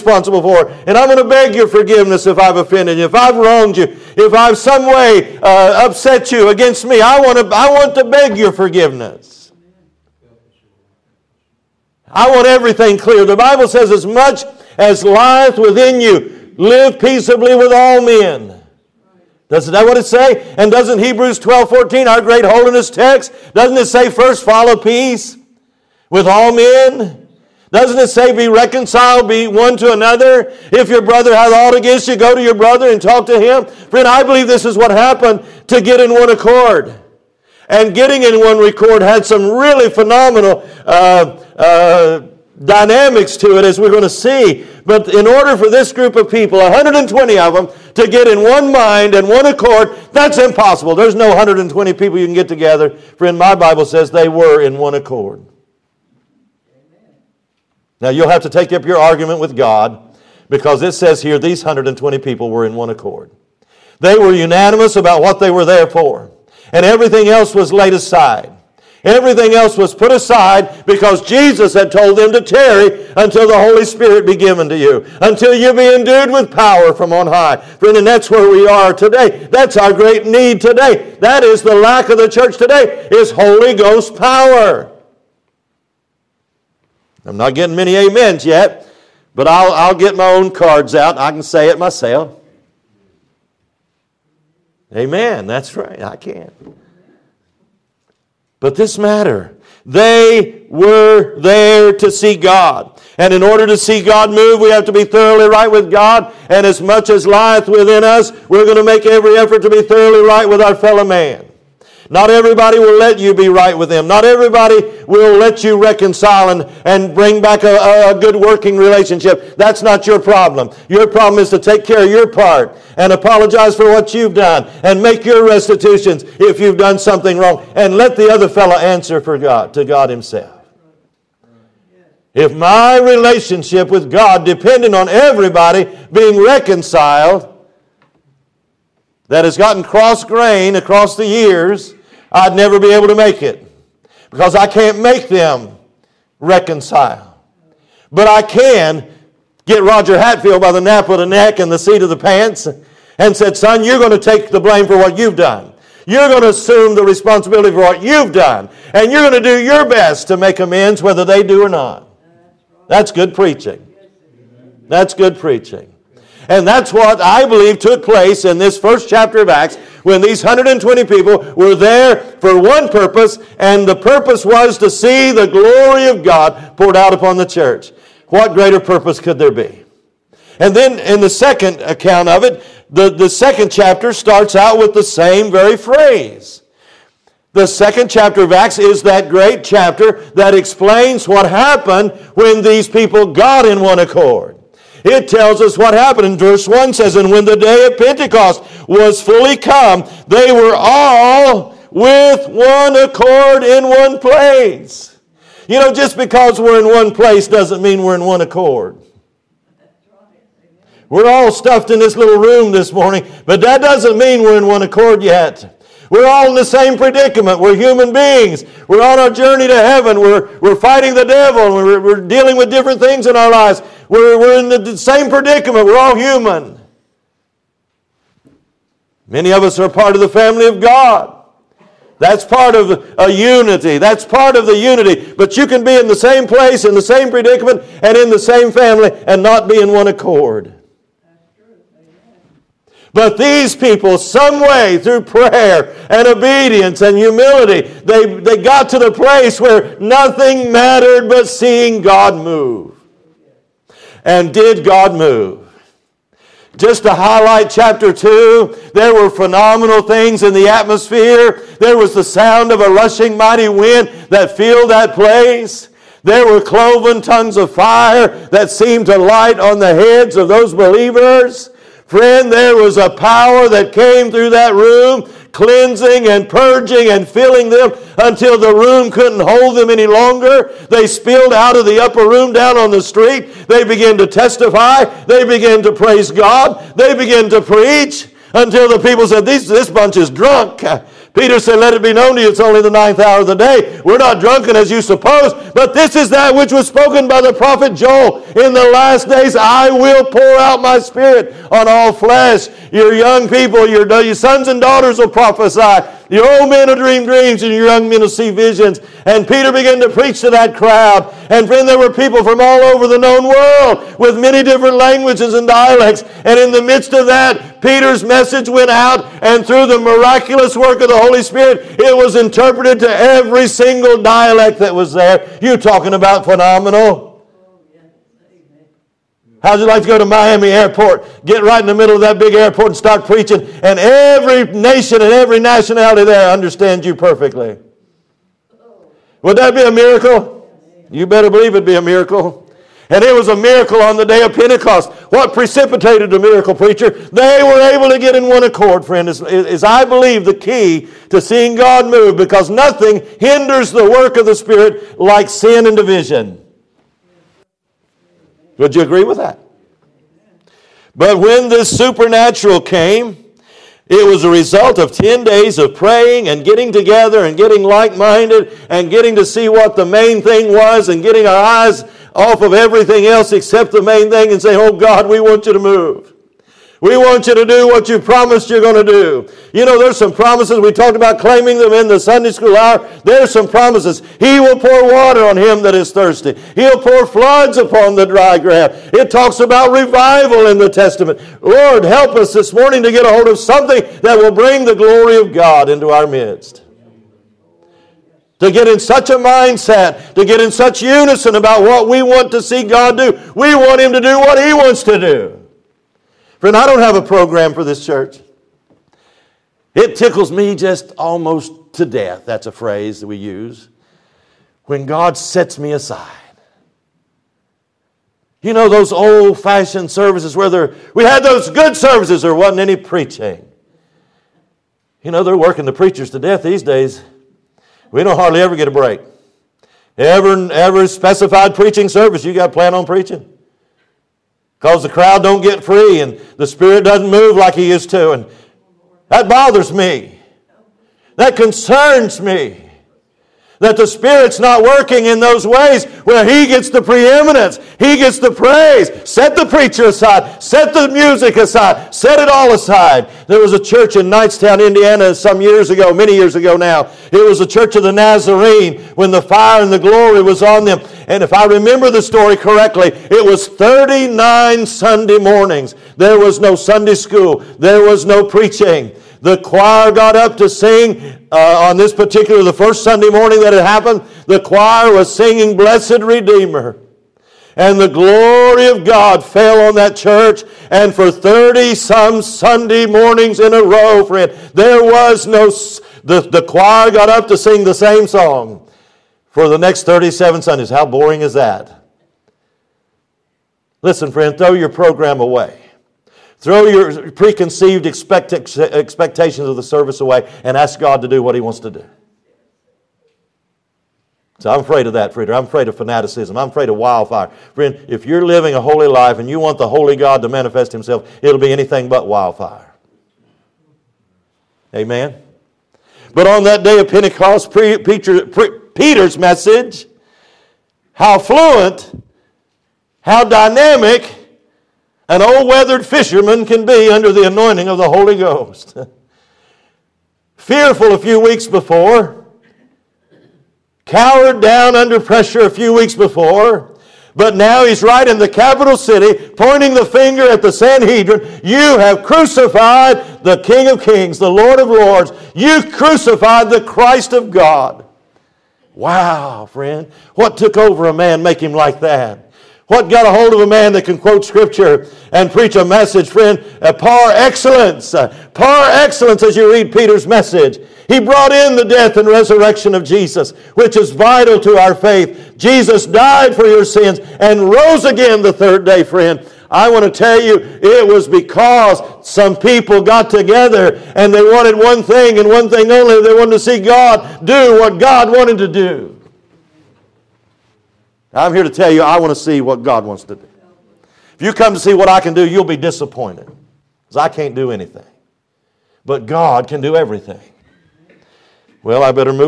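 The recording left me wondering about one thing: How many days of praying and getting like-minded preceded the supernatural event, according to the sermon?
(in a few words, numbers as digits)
10.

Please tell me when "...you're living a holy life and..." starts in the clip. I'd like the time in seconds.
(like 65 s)
508 s.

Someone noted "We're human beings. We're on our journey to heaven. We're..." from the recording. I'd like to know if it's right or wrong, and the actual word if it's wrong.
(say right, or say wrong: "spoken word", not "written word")
right.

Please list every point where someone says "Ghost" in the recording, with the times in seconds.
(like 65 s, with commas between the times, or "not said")
83 s, 528 s.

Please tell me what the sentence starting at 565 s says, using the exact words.
Jesus died for your sins and rose again the third day, friend.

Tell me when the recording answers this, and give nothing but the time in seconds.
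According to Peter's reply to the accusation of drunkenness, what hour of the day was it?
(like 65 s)
292 s.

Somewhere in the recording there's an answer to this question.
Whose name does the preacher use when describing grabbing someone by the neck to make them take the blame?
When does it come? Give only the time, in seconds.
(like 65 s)
149 s.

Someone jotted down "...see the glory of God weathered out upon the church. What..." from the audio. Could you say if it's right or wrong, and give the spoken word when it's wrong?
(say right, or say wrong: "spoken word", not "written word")
wrong: "poured", not "weathered".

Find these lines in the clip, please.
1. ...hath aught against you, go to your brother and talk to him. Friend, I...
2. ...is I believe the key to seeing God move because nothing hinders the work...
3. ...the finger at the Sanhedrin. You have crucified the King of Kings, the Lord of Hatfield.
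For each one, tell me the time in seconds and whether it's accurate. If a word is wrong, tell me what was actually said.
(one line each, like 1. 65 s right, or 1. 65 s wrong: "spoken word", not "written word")
1. 31 s right
2. 349 s right
3. 539 s wrong: "Lords", not "Hatfield".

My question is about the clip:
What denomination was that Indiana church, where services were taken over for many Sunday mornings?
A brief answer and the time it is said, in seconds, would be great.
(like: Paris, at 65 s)
Church of the Nazarene, at 457 s.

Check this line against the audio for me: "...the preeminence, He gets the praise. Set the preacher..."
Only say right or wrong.
right.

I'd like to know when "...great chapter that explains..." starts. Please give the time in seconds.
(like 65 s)
189 s.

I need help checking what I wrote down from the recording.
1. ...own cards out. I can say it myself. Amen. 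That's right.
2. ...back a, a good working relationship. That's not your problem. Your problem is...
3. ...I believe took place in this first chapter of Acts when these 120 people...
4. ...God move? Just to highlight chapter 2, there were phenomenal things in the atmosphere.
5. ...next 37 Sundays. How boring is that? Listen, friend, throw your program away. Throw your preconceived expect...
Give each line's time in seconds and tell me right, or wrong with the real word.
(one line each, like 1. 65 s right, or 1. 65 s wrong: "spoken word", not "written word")
1. 90 s right
2. 117 s right
3. 167 s right
4. 254 s right
5. 489 s right.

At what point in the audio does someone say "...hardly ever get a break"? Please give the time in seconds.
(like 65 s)
428 s.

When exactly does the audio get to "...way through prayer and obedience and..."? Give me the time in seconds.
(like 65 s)
244 s.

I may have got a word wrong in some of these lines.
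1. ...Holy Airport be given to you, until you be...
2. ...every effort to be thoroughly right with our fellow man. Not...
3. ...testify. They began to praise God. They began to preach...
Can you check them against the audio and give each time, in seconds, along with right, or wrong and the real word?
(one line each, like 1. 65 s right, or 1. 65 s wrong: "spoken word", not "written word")
1. 73 s wrong: "Spirit", not "Airport"
2. 109 s right
3. 284 s right.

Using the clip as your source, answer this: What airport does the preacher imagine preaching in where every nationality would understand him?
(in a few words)
Miami Airport.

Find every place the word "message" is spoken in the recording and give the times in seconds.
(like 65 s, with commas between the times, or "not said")
318 s, 519 s, 555 s, 560 s.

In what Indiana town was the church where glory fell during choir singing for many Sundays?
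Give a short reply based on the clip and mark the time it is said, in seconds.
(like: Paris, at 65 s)
Knightstown, at 454 s.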